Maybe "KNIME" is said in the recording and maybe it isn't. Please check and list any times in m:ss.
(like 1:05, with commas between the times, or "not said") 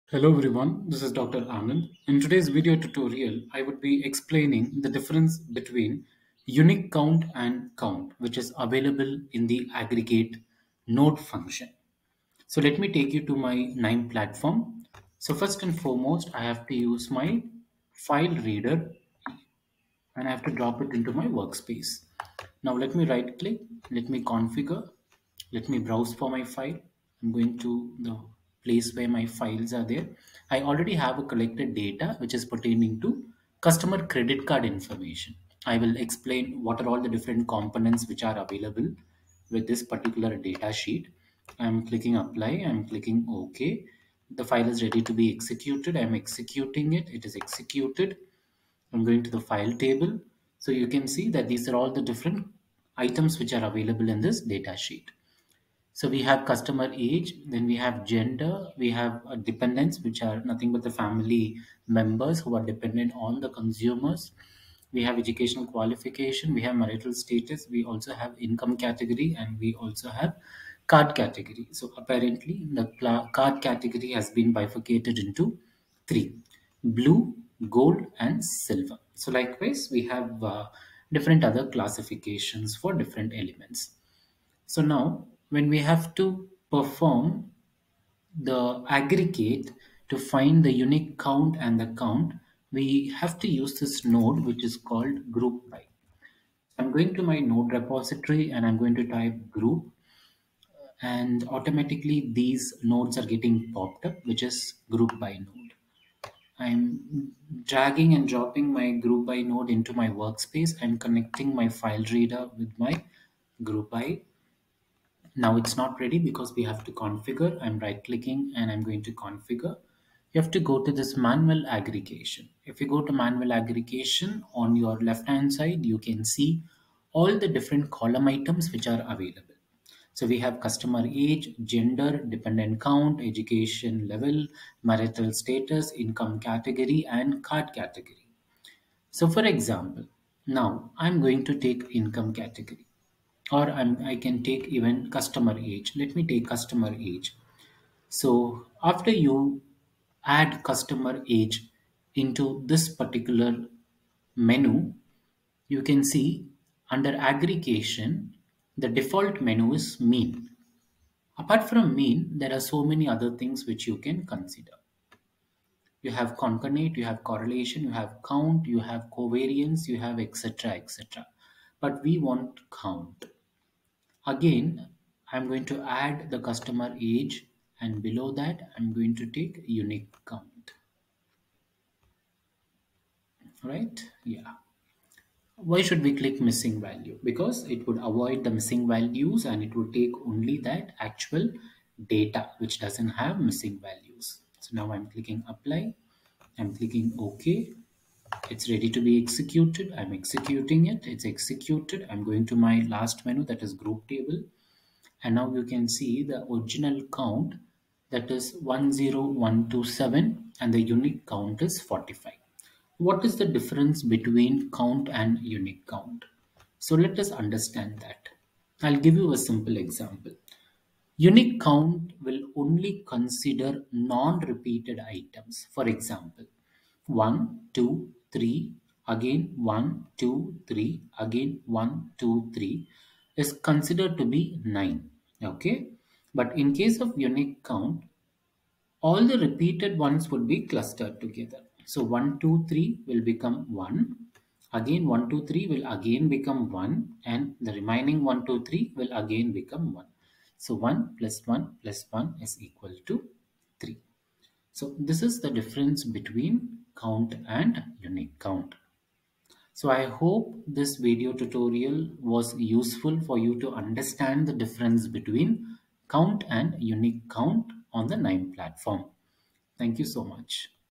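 0:13, 4:28.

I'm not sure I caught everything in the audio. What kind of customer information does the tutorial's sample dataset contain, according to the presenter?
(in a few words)
Credit card information.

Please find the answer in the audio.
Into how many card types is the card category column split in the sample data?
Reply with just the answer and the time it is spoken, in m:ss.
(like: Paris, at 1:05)
3, at 1:16.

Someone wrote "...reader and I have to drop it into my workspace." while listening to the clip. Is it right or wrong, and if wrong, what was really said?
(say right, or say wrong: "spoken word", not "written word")
right.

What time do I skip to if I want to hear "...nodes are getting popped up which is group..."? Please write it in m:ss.
1:42.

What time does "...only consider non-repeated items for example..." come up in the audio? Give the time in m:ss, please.
3:42.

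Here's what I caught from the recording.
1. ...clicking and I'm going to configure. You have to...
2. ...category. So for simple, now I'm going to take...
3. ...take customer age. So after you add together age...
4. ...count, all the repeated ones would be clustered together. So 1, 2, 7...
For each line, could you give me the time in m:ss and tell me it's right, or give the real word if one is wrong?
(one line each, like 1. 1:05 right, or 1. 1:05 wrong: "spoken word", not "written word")
1. 1:58 right
2. 2:17 wrong: "example", not "simple"
3. 2:26 wrong: "customer", not "together"
4. 3:57 wrong: "3", not "7".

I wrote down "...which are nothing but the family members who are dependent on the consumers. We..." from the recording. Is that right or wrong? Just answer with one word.
right.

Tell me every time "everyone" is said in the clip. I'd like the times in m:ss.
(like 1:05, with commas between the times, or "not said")
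0:00.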